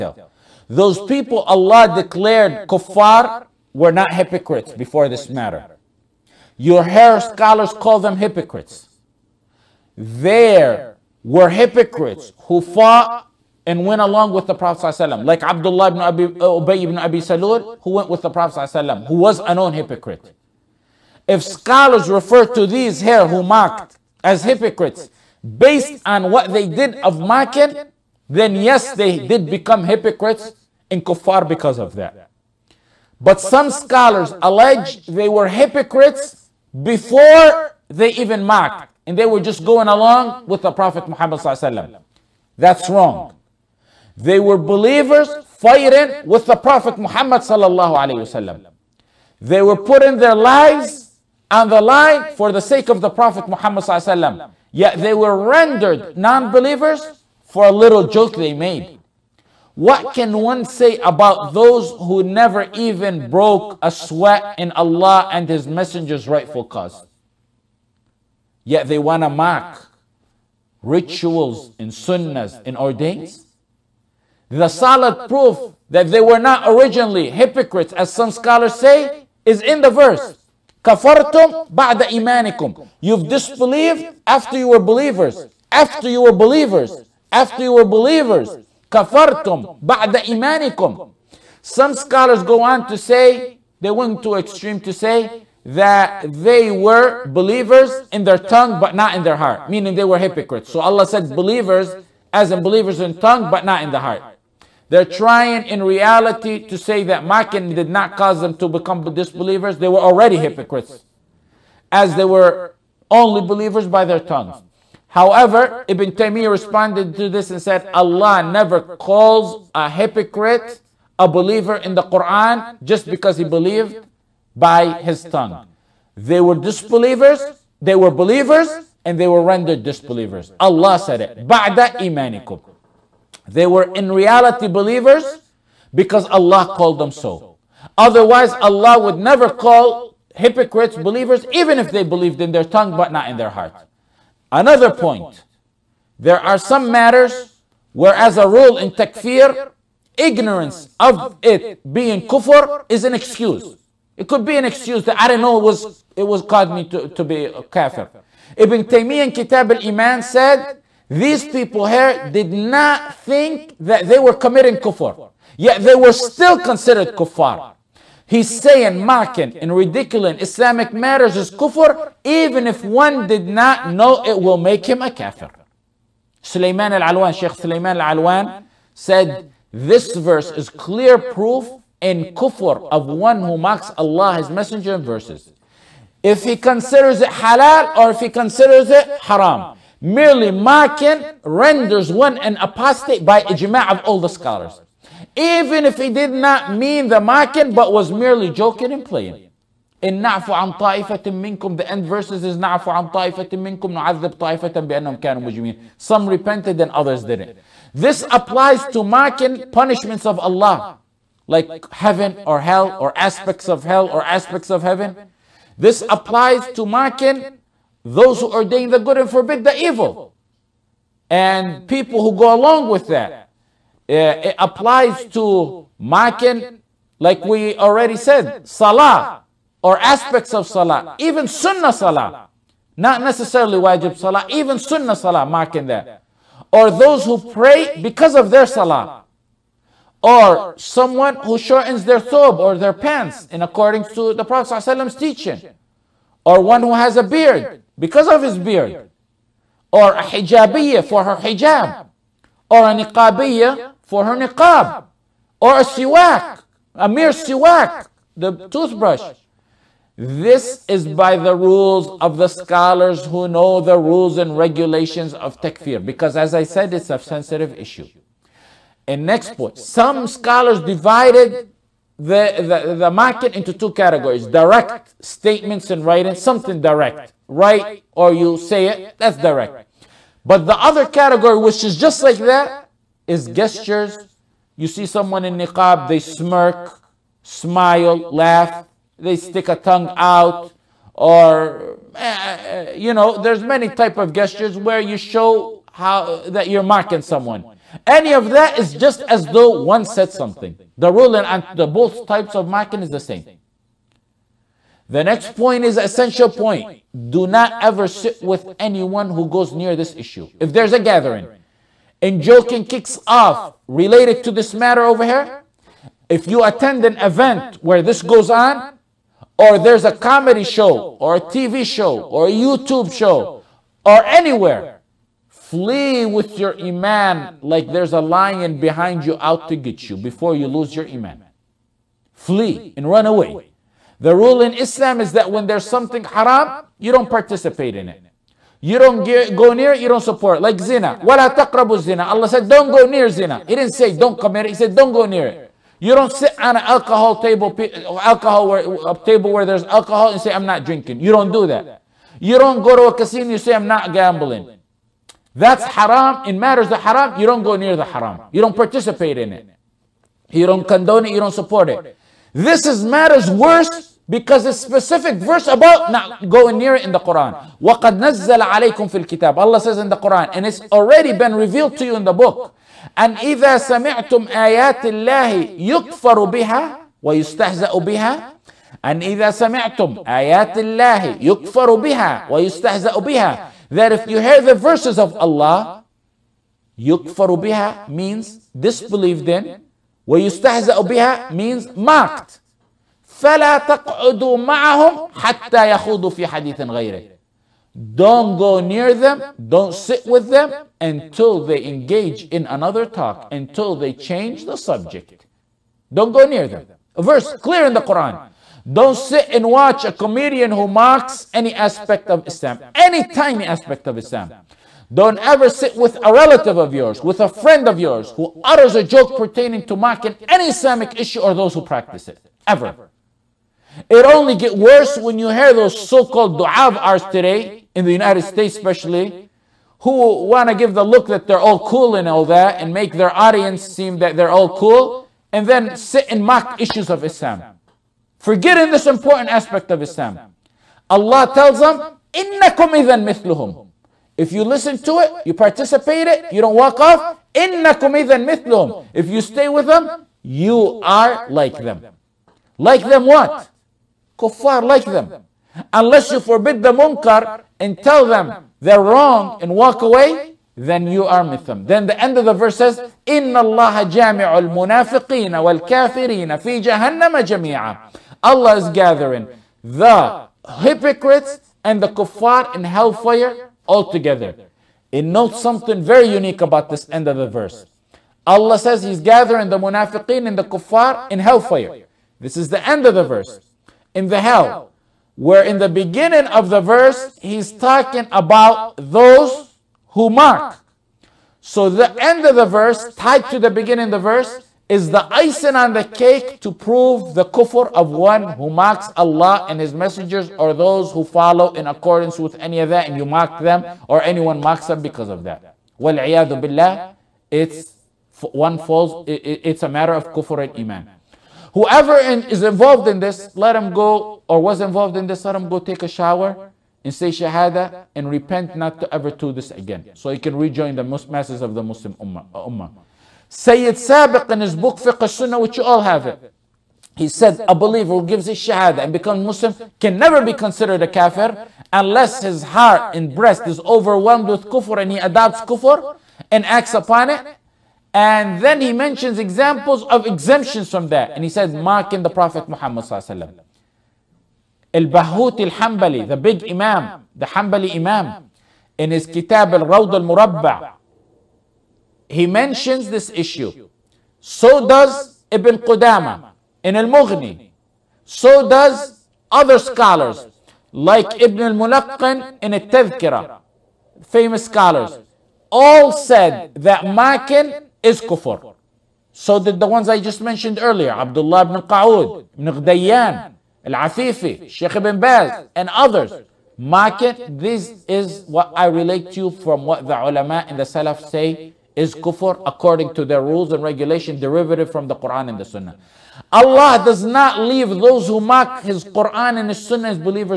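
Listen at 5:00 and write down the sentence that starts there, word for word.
The rule and the both types of mocking is the same.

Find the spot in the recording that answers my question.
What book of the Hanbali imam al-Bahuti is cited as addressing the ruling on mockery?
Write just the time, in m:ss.
9:09.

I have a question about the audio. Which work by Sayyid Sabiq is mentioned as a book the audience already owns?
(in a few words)
Fiqh Sunnah.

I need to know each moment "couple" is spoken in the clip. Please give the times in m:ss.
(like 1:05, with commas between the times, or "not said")
not said.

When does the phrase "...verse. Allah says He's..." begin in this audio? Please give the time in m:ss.
7:57.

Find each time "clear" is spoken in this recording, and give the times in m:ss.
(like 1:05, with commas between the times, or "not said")
3:00, 6:47.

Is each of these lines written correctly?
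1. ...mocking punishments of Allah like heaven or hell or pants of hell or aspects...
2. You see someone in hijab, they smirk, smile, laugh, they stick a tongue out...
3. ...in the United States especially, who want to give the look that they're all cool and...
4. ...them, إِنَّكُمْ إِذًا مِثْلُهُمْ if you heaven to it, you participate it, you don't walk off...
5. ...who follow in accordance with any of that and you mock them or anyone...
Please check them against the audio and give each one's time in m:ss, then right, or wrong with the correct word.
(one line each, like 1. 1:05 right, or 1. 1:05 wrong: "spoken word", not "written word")
1. 3:29 wrong: "aspects", not "pants"
2. 4:44 wrong: "niqab", not "hijab"
3. 7:07 right
4. 7:21 wrong: "listen", not "heaven"
5. 8:21 right.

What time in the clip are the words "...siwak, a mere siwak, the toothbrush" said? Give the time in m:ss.
4:15.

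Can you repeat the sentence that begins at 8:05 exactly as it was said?
Where in the beginning of the verse, He's talking about those who mock.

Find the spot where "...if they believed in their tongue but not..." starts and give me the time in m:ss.
2:21.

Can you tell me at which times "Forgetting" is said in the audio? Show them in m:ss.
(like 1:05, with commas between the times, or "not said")
7:18.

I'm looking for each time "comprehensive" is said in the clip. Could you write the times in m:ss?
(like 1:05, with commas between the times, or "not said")
not said.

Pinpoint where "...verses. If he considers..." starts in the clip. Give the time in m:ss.
3:05.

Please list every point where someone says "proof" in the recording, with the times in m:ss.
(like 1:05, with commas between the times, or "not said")
1:15, 3:01.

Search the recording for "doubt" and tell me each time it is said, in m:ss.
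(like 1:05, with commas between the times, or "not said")
not said.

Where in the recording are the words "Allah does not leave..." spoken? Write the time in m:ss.
9:46.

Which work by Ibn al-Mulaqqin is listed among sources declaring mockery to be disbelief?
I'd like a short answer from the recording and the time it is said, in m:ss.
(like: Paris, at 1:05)
Al-Tadhkira, at 9:22.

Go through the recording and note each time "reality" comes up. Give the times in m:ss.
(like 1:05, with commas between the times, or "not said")
1:45, 2:14.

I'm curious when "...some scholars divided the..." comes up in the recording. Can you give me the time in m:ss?
4:29.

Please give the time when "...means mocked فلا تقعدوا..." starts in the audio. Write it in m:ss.
6:31.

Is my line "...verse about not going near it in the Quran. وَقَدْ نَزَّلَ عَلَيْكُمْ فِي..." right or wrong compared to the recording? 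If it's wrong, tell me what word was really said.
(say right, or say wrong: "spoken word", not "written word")
right.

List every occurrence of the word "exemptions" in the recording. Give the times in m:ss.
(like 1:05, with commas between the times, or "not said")
9:00.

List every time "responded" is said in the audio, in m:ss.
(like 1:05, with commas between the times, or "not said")
1:56.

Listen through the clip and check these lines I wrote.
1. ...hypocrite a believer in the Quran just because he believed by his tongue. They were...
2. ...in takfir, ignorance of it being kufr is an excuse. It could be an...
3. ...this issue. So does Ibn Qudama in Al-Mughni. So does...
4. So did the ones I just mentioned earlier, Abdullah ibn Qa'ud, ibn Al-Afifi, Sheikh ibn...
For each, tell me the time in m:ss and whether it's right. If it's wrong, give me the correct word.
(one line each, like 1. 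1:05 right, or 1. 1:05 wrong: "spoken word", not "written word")
1. 1:59 right
2. 2:28 right
3. 9:13 right
4. 9:29 right.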